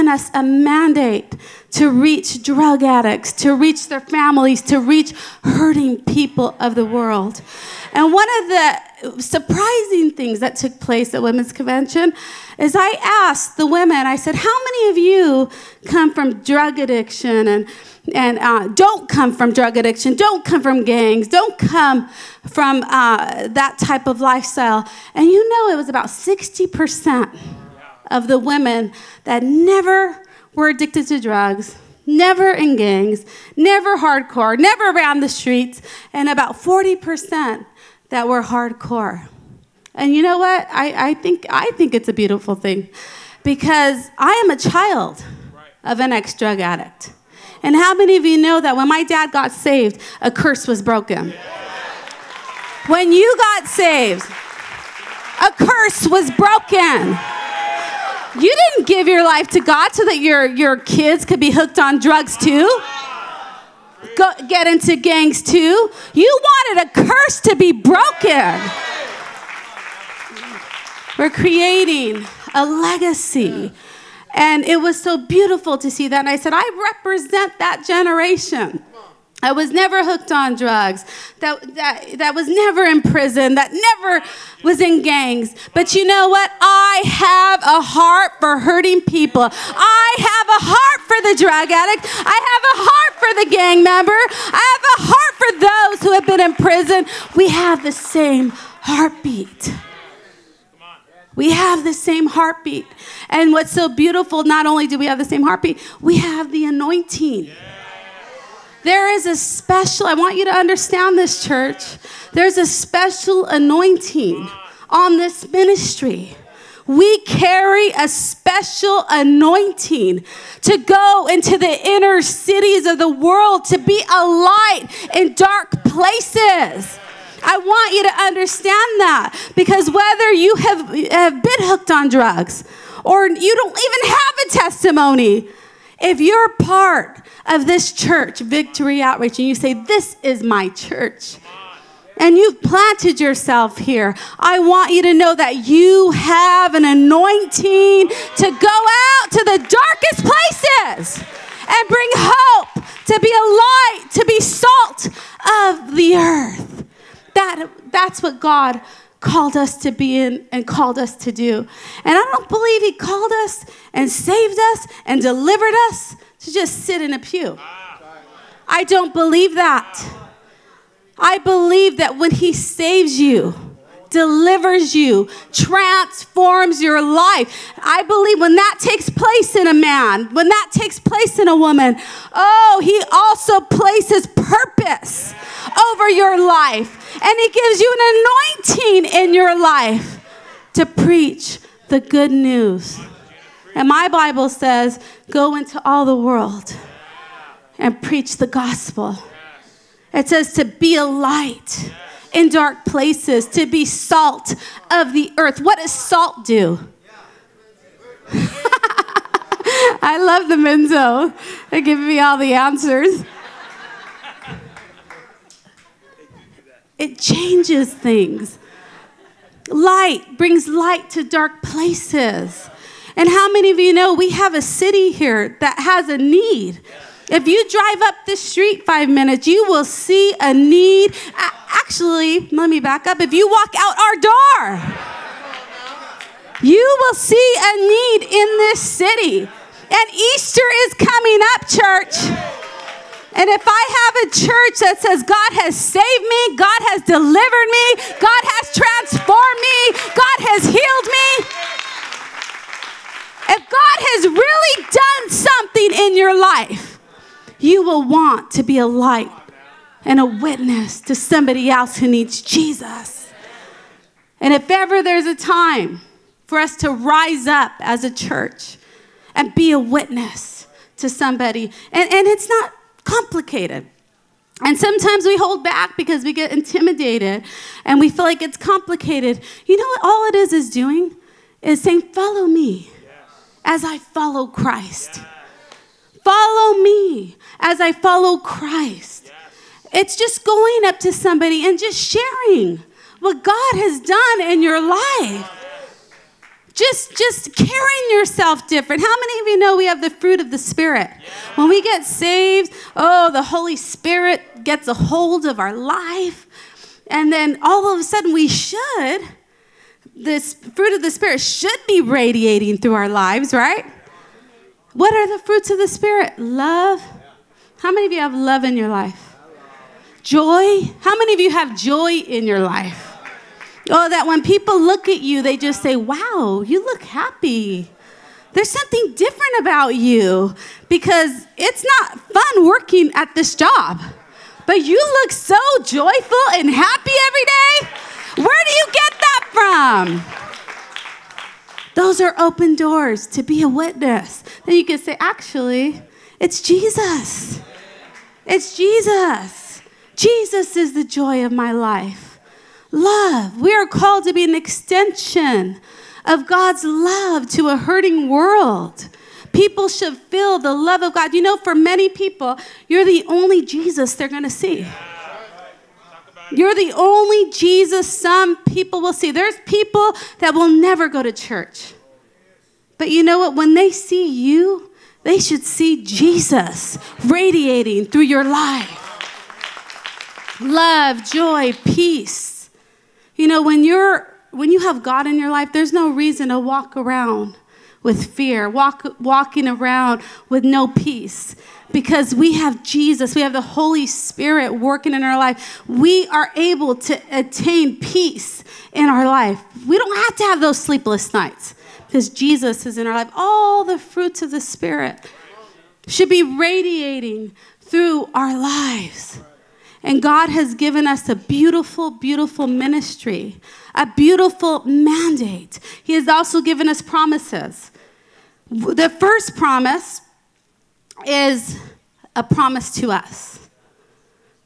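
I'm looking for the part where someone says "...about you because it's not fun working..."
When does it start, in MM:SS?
05:29.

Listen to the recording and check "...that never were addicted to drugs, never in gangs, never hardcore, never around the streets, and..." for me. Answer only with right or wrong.
right.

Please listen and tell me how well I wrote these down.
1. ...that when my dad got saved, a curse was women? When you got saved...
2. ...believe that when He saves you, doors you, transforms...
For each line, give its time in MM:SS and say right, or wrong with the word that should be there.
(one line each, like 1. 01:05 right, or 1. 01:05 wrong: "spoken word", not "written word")
1. 00:48 wrong: "broken", not "women"
2. 02:51 wrong: "delivers", not "doors".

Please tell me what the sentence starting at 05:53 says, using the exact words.
We are called to be an extension of God's love to a hurting world.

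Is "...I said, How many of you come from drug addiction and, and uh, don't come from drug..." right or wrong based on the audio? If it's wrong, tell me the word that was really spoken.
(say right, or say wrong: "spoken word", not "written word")
right.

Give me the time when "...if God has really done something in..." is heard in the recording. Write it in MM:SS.
04:13.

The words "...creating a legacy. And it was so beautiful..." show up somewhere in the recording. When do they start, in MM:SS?
01:11.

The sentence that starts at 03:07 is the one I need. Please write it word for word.
And He gives you an anointing in your life to preach the good news.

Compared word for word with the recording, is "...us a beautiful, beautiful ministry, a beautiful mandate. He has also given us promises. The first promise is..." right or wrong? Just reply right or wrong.
right.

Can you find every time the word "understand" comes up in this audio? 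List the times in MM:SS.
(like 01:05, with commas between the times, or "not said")
01:50, 02:08.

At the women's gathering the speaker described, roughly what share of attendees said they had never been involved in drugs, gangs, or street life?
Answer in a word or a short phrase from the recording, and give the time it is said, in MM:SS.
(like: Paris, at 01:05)
60%, at 00:26.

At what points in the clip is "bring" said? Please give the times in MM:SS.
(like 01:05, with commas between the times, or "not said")
02:31, 03:40.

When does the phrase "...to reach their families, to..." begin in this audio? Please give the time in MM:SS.
00:03.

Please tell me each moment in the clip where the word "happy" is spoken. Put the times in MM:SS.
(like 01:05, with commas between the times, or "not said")
05:27, 05:36.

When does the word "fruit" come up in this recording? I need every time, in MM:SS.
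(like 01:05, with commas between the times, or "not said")
05:00, 05:10, 05:15, 06:43.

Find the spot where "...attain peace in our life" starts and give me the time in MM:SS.
06:37.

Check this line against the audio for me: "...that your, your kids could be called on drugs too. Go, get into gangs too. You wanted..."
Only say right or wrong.
wrong.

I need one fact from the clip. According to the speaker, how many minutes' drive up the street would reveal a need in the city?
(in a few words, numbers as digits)
5.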